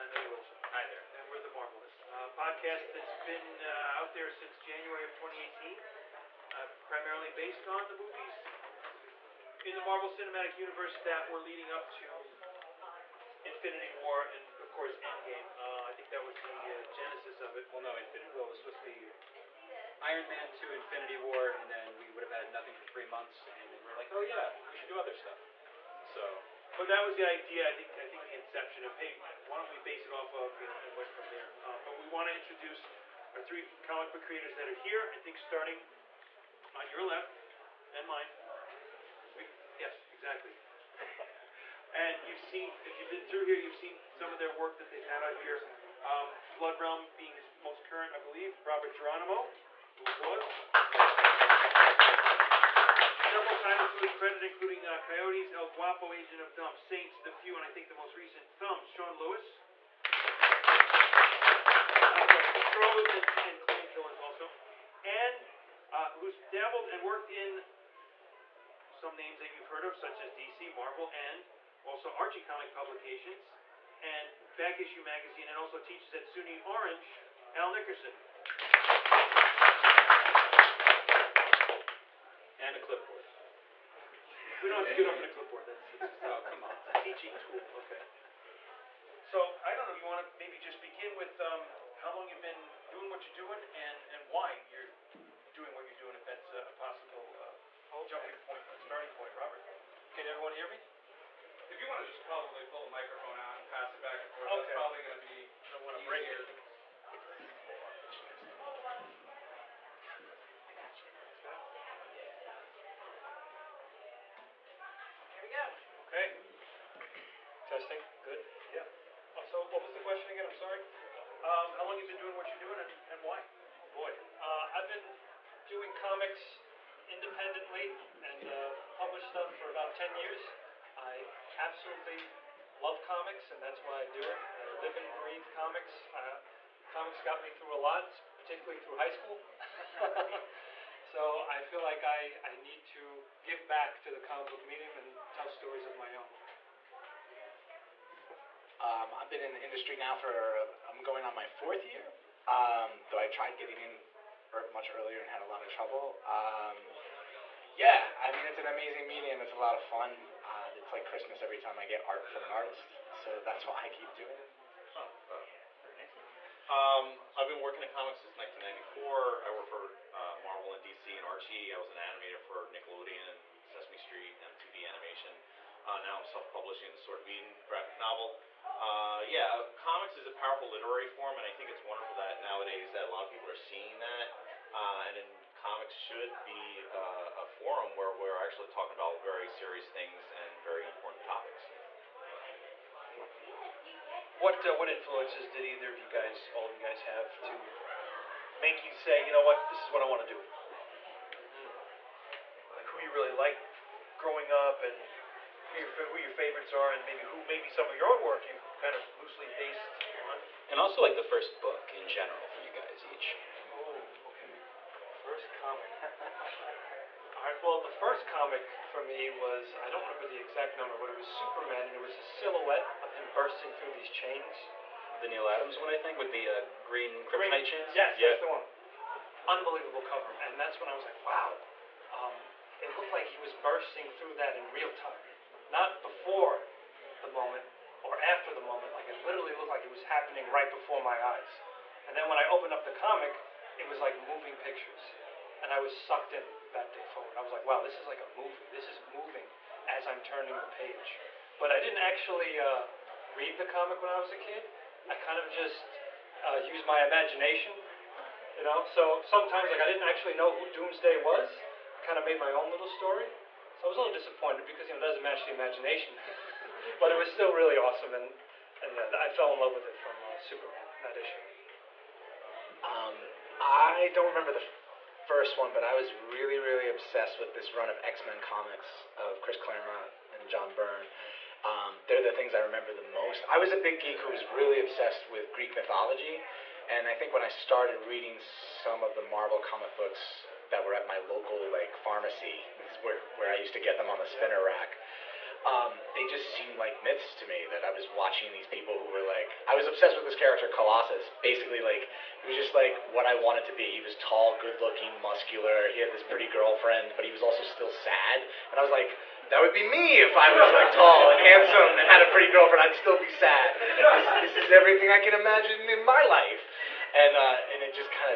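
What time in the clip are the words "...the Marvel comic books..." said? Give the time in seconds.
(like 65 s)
289 s.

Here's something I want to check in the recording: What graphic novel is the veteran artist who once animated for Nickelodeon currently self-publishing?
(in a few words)
Sword of Eden.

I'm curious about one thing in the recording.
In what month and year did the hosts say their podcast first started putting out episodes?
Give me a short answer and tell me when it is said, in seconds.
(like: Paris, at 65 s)
January 2018, at 4 s.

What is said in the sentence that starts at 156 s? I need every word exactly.
Um, yeah, I mean, it's an amazing medium.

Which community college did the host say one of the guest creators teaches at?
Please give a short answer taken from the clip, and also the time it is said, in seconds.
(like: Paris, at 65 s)
SUNY Orange, at 76 s.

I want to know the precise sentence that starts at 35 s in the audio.
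I think starting on your left and mine.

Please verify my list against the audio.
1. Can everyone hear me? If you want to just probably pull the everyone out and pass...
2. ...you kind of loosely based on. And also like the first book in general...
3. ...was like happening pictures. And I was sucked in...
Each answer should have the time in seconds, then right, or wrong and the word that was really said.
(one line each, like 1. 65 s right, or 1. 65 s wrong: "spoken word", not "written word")
1. 100 s wrong: "microphone", not "everyone"
2. 208 s right
3. 243 s wrong: "moving", not "happening".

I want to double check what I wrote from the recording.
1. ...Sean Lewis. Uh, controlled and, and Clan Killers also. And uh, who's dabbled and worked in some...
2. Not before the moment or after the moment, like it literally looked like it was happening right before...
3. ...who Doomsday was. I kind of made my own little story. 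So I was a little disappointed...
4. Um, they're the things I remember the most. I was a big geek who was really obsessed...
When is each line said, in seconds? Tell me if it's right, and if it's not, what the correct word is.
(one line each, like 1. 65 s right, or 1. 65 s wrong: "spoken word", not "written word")
1. 58 s right
2. 235 s right
3. 260 s right
4. 281 s right.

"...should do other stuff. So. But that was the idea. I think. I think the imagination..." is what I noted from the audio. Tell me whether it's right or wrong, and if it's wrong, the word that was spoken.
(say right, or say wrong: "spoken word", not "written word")
wrong: "inception", not "imagination".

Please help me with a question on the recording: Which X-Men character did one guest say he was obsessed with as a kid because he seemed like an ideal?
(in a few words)
Colossus.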